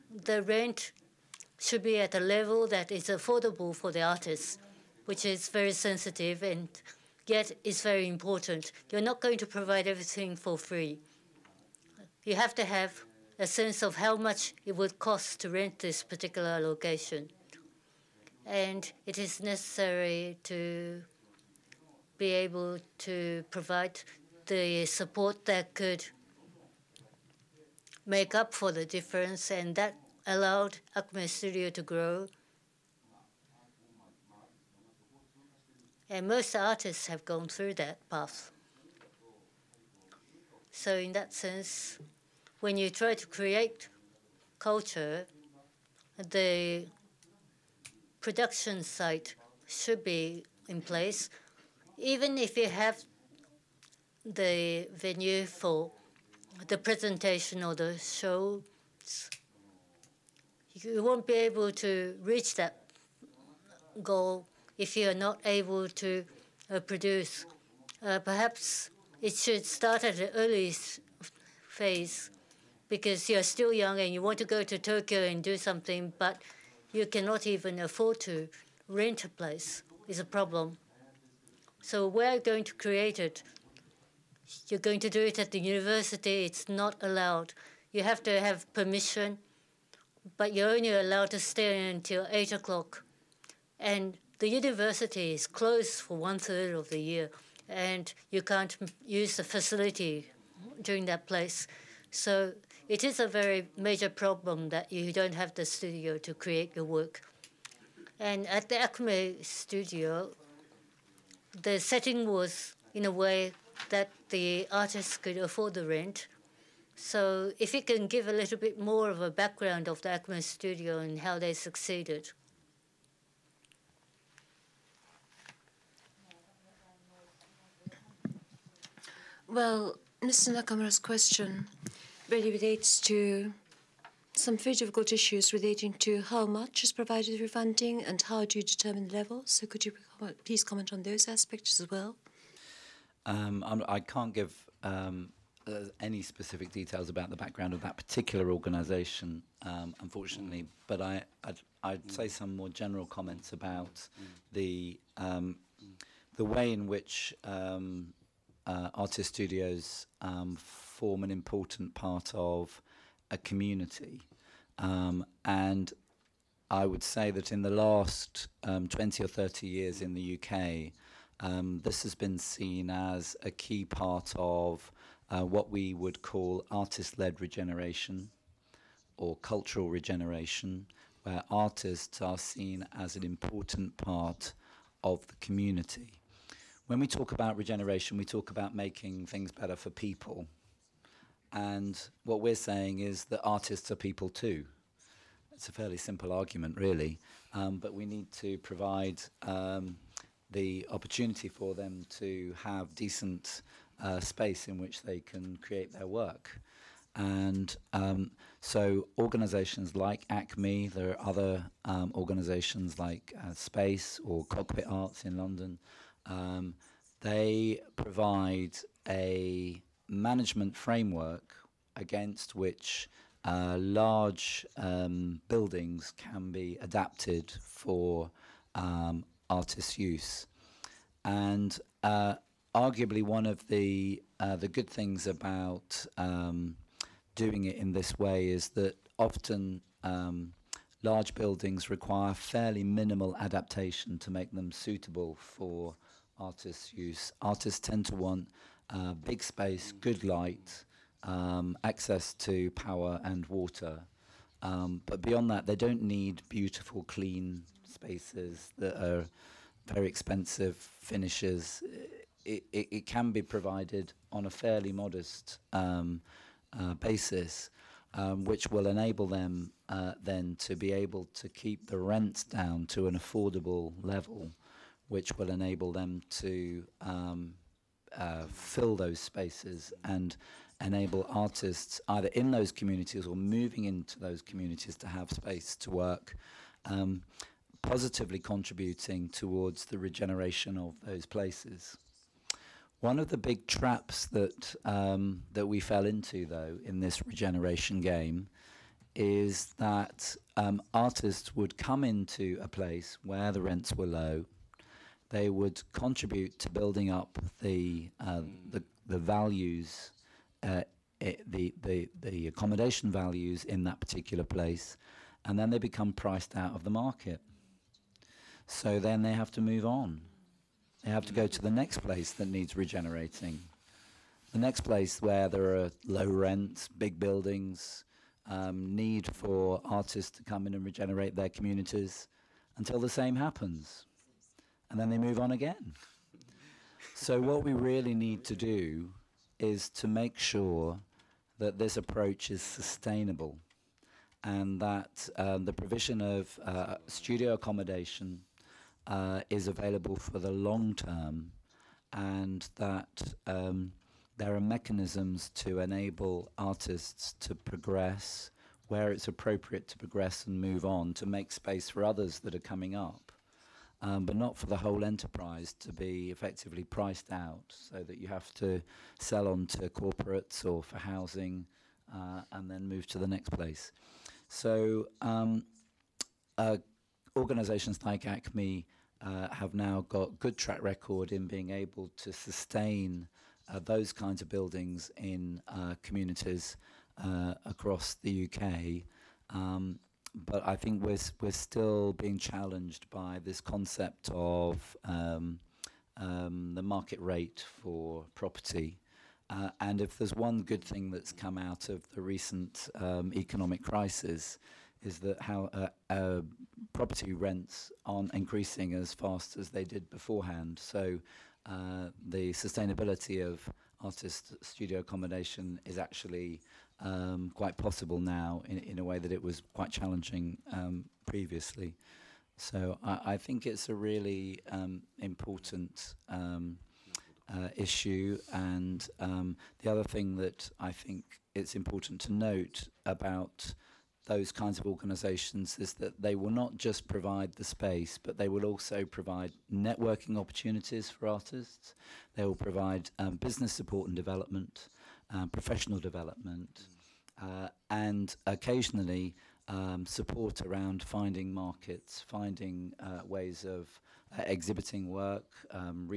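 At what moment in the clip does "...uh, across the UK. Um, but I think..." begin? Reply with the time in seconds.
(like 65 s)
387 s.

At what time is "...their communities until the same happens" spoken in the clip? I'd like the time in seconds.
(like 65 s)
331 s.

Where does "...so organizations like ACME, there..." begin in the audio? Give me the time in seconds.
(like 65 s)
208 s.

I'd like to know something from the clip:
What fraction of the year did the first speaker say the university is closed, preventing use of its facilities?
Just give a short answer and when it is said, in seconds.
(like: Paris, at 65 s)
one third, at 96 s.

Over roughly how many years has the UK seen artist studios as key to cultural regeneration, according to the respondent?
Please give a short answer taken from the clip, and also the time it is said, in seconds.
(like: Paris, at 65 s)
20 or 30 years, at 168 s.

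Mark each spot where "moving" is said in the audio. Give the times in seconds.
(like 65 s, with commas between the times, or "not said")
283 s.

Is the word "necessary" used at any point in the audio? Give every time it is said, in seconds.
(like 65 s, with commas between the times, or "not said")
19 s.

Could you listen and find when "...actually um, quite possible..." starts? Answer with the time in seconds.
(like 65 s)
415 s.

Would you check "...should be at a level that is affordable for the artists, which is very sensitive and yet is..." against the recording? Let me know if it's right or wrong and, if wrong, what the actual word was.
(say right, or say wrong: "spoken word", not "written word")
right.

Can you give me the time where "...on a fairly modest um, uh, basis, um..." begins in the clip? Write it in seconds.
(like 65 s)
264 s.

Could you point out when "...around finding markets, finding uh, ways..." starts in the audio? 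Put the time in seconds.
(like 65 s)
450 s.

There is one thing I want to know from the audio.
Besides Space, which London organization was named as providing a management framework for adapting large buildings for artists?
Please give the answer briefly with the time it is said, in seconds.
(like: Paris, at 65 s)
Cockpit Arts, at 214 s.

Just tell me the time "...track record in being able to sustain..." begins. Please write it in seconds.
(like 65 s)
380 s.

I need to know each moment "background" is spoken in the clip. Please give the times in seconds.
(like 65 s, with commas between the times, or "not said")
119 s, 147 s.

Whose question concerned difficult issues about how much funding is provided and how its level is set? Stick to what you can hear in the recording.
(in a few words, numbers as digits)
Mr. Nakamura.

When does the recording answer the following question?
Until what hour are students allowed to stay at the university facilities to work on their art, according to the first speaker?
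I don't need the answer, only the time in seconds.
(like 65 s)
92 s.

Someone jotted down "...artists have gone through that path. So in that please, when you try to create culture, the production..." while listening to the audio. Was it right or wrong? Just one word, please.
wrong.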